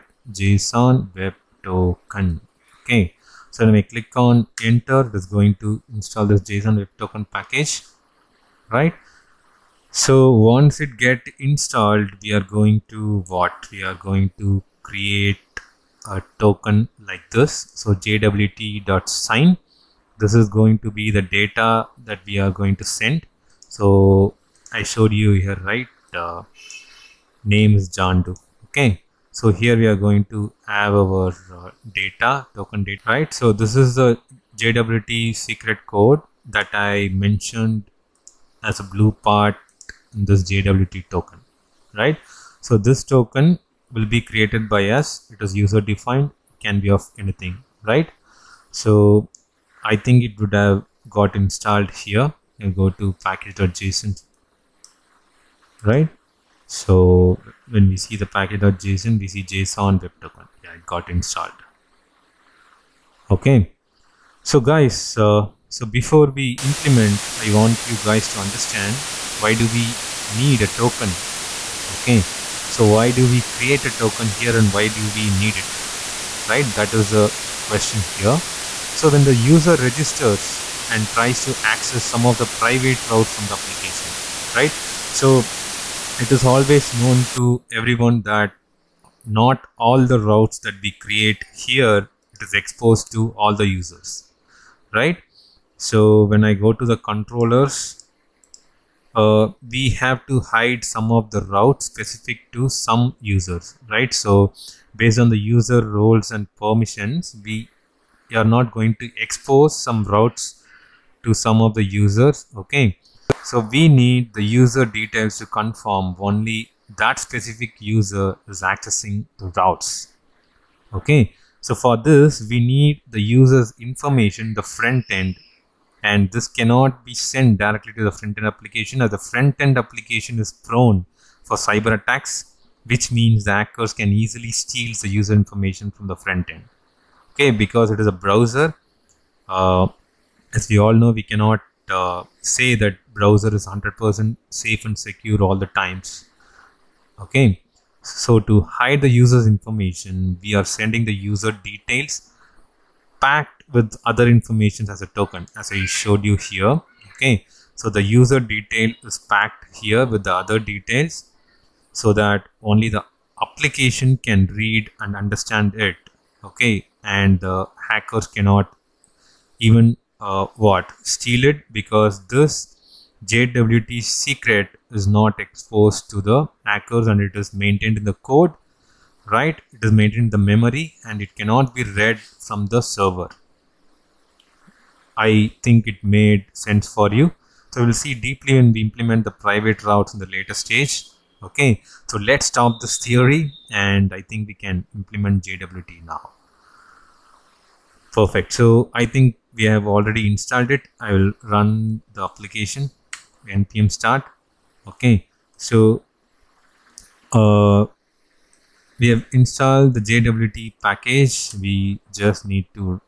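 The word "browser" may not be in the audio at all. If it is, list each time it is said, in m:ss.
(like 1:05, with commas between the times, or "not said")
2:18, 2:23.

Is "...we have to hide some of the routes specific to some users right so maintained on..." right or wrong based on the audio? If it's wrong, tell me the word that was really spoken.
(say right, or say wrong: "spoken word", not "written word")
wrong: "based", not "maintained".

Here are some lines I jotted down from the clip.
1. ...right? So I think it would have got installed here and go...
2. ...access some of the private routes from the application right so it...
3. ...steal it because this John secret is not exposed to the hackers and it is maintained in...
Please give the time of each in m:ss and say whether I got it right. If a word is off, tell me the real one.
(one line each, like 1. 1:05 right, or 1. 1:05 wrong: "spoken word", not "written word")
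1. 0:47 right
2. 1:21 right
3. 2:51 wrong: "JWT", not "John".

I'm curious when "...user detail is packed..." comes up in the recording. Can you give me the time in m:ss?
2:38.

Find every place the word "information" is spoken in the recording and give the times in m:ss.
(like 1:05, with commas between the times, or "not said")
2:03, 2:15, 2:29, 2:34.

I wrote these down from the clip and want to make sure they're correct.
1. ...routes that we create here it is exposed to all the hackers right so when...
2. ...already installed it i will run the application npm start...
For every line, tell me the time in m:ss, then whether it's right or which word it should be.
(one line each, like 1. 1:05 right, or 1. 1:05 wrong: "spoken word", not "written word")
1. 1:30 wrong: "users", not "hackers"
2. 3:19 right.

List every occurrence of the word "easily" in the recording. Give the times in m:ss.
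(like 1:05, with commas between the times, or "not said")
2:14.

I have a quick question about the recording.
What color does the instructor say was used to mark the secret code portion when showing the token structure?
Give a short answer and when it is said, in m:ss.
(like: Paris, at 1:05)
Blue, at 0:38.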